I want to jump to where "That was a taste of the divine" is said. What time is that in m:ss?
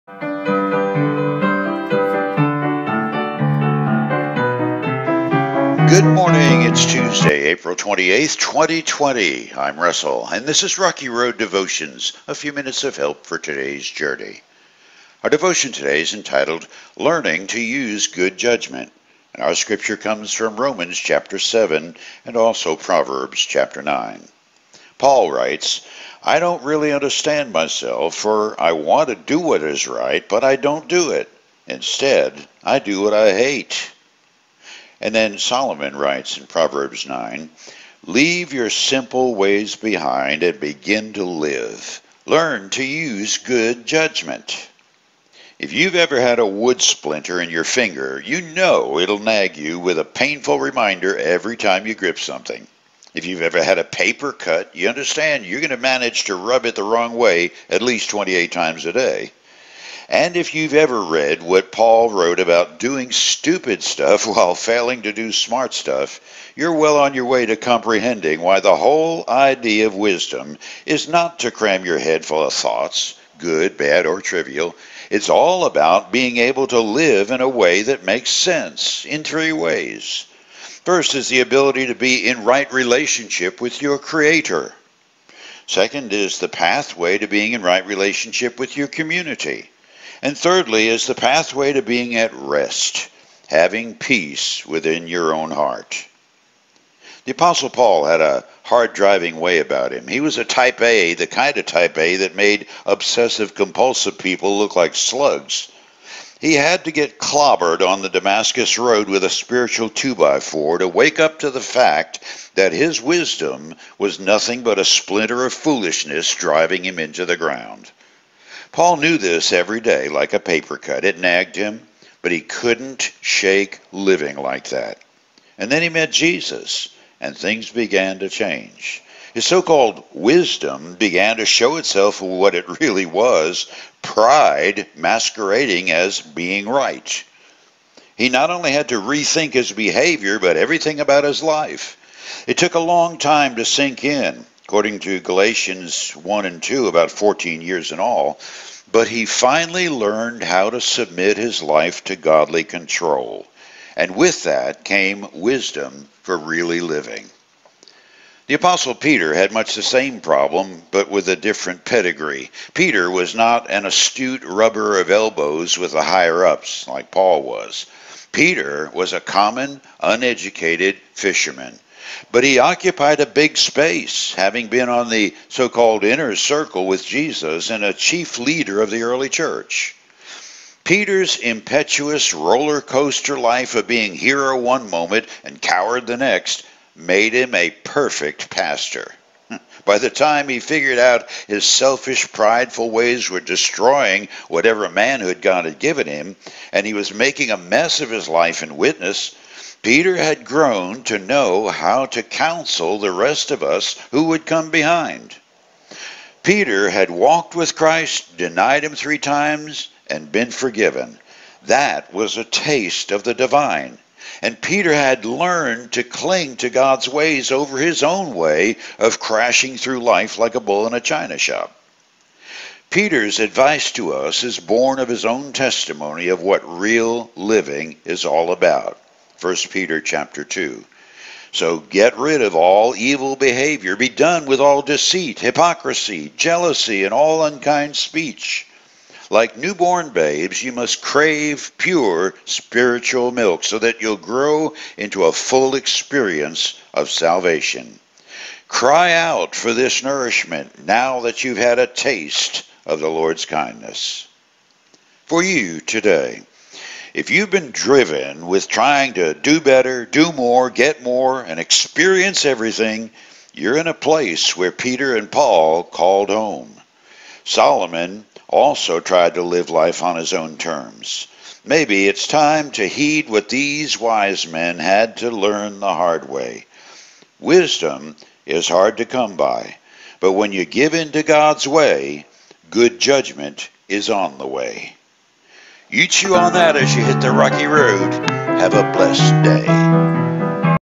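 3:31.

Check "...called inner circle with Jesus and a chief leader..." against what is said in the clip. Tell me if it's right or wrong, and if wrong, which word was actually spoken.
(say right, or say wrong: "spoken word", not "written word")
right.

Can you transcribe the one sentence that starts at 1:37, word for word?
The Apostle Paul had a hard driving way about him.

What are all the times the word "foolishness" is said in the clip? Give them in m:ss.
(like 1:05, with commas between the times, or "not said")
1:55.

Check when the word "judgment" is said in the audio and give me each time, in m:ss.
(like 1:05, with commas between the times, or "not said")
0:18, 0:43, 4:43.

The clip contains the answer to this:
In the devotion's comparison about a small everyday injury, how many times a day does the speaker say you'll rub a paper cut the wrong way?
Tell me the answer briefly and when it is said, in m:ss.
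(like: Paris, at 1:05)
28, at 0:58.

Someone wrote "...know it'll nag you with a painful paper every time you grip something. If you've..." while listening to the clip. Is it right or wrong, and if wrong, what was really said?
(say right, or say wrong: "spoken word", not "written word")
wrong: "reminder", not "paper".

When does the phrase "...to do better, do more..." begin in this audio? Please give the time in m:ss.
4:19.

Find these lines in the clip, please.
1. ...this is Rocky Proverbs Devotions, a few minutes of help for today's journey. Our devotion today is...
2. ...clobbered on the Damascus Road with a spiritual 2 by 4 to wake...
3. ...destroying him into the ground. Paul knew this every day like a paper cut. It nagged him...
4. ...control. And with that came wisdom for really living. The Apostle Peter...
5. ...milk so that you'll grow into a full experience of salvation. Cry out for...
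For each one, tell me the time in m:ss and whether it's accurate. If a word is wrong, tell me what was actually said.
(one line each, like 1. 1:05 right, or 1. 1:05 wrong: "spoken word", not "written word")
1. 0:10 wrong: "Road", not "Proverbs"
2. 1:47 right
3. 1:56 wrong: "driving", not "destroying"
4. 2:32 right
5. 4:03 right.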